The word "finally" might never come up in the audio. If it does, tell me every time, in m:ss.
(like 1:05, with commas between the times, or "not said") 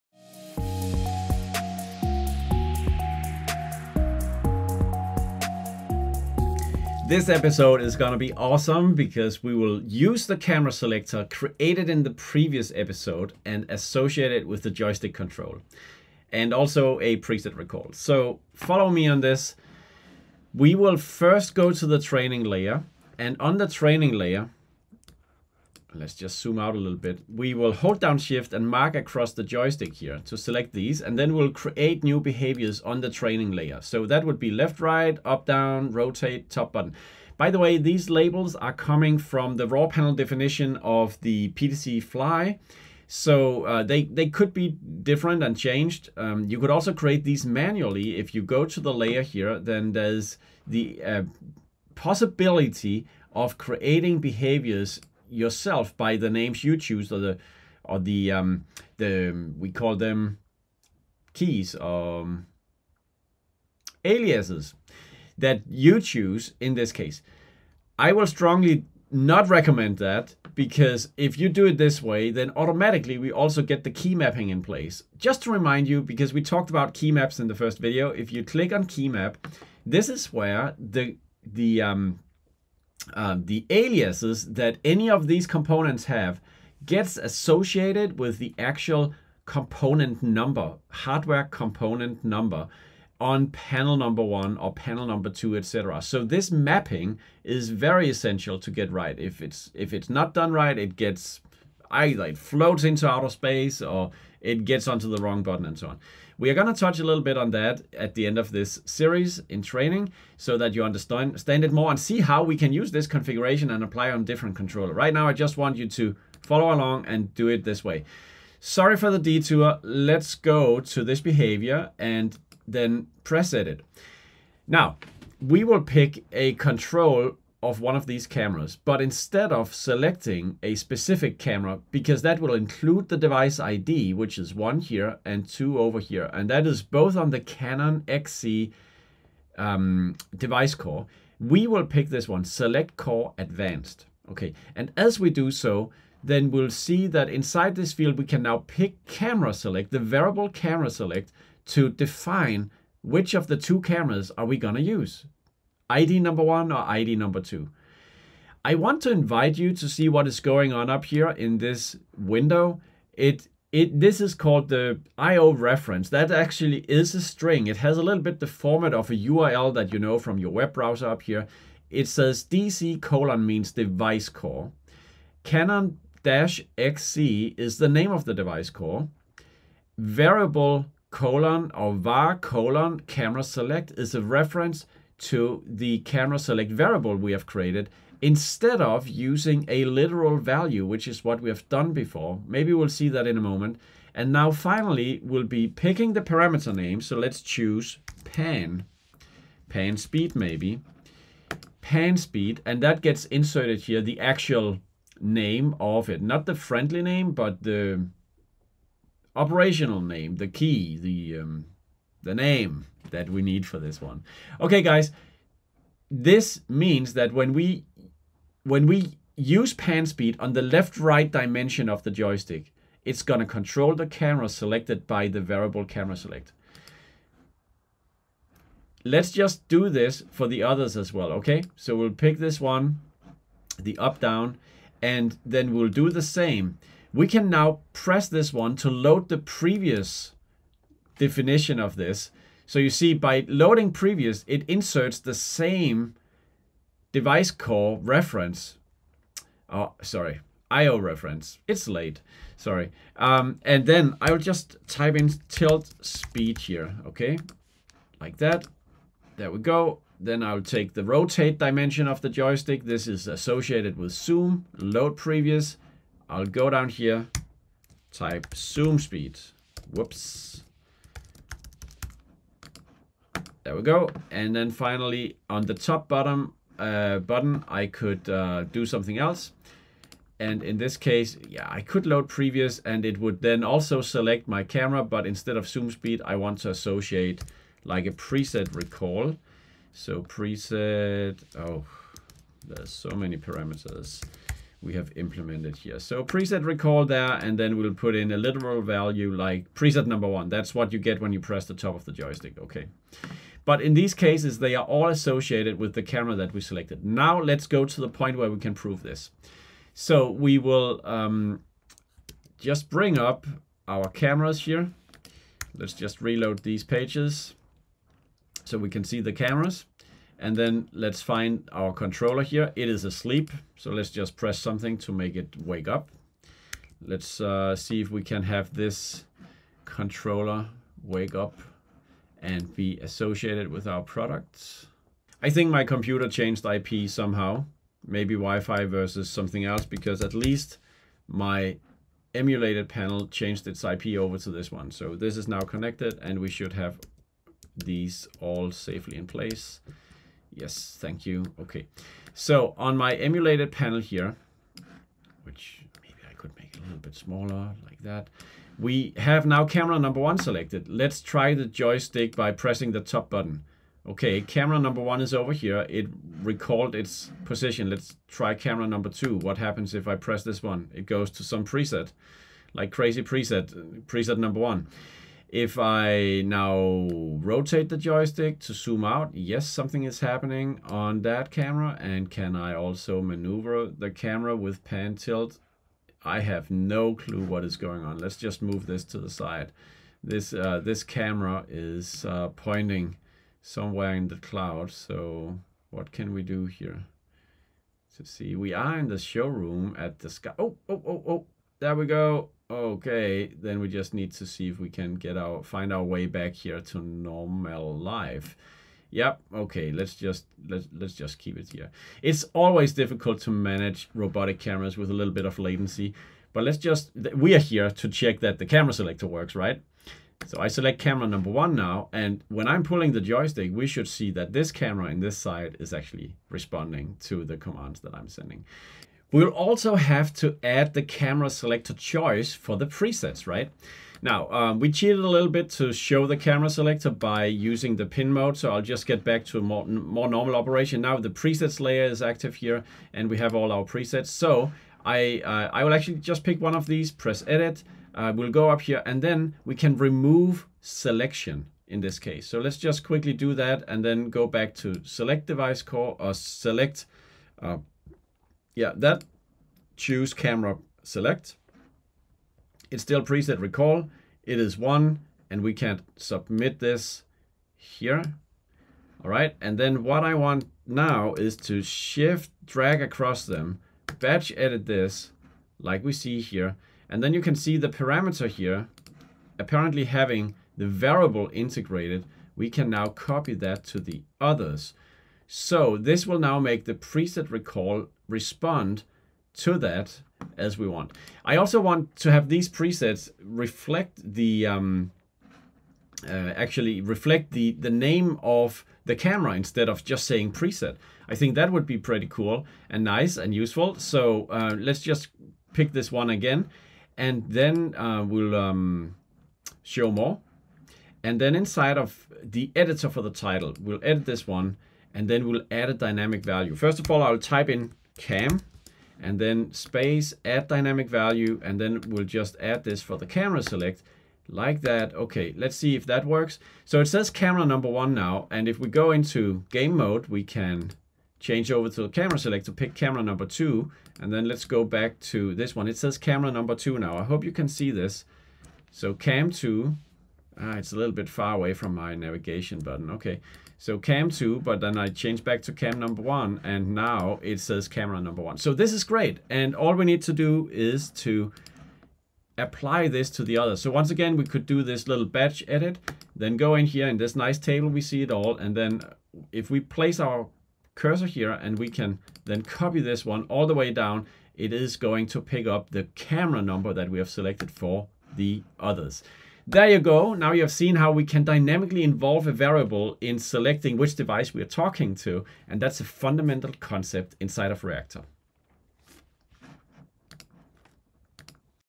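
3:14, 4:34.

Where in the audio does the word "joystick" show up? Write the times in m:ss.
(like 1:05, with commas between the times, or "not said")
0:14, 0:29, 3:42, 4:22, 5:02, 6:01, 6:17, 7:03.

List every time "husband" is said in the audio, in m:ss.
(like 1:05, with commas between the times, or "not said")
not said.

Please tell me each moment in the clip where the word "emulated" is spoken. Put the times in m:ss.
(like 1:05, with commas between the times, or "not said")
5:42, 5:53.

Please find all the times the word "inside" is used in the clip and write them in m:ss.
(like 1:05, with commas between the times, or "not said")
2:27, 8:31, 9:37.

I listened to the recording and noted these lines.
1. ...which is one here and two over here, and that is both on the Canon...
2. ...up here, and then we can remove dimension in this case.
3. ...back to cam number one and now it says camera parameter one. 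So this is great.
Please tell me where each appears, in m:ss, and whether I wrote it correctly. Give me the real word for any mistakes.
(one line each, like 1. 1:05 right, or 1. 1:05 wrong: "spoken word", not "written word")
1. 2:14 right
2. 7:28 wrong: "selection", not "dimension"
3. 9:05 wrong: "number", not "parameter".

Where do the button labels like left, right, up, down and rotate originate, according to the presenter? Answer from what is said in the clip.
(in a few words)
raw panel definition of the PTZ Fly.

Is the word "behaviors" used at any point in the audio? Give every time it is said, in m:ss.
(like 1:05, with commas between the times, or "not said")
0:32, 0:54, 2:01.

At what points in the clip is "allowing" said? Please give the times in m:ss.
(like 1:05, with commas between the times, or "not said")
not said.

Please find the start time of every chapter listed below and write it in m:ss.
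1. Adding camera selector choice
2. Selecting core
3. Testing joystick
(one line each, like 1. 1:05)
1. 7:11
2. 1:58
3. 5:50.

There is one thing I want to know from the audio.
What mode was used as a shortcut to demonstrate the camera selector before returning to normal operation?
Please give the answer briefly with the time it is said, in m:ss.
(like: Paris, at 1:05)
pin mode, at 7:18.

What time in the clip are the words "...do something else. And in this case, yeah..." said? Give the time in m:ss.
4:38.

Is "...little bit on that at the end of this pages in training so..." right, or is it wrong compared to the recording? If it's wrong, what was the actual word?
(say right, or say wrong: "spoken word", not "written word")
wrong: "series", not "pages".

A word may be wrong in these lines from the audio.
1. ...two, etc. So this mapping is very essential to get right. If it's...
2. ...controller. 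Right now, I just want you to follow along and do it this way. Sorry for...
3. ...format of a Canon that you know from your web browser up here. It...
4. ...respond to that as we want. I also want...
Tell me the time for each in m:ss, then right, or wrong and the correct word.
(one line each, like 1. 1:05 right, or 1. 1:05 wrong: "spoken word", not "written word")
1. 1:35 right
2. 1:54 right
3. 2:48 wrong: "URL", not "Canon"
4. 8:08 right.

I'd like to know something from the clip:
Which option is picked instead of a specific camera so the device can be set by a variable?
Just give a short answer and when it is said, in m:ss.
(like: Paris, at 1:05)
Select Core Advanced, at 2:22.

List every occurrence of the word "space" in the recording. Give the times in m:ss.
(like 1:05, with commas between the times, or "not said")
1:43, 8:39.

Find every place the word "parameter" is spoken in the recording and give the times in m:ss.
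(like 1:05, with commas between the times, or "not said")
3:16, 4:53, 7:57.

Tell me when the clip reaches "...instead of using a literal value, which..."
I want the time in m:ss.
3:08.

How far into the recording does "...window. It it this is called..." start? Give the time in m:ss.
2:42.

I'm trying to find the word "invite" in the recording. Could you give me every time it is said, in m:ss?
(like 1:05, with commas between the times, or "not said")
2:39.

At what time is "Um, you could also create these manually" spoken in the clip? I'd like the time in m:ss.
0:46.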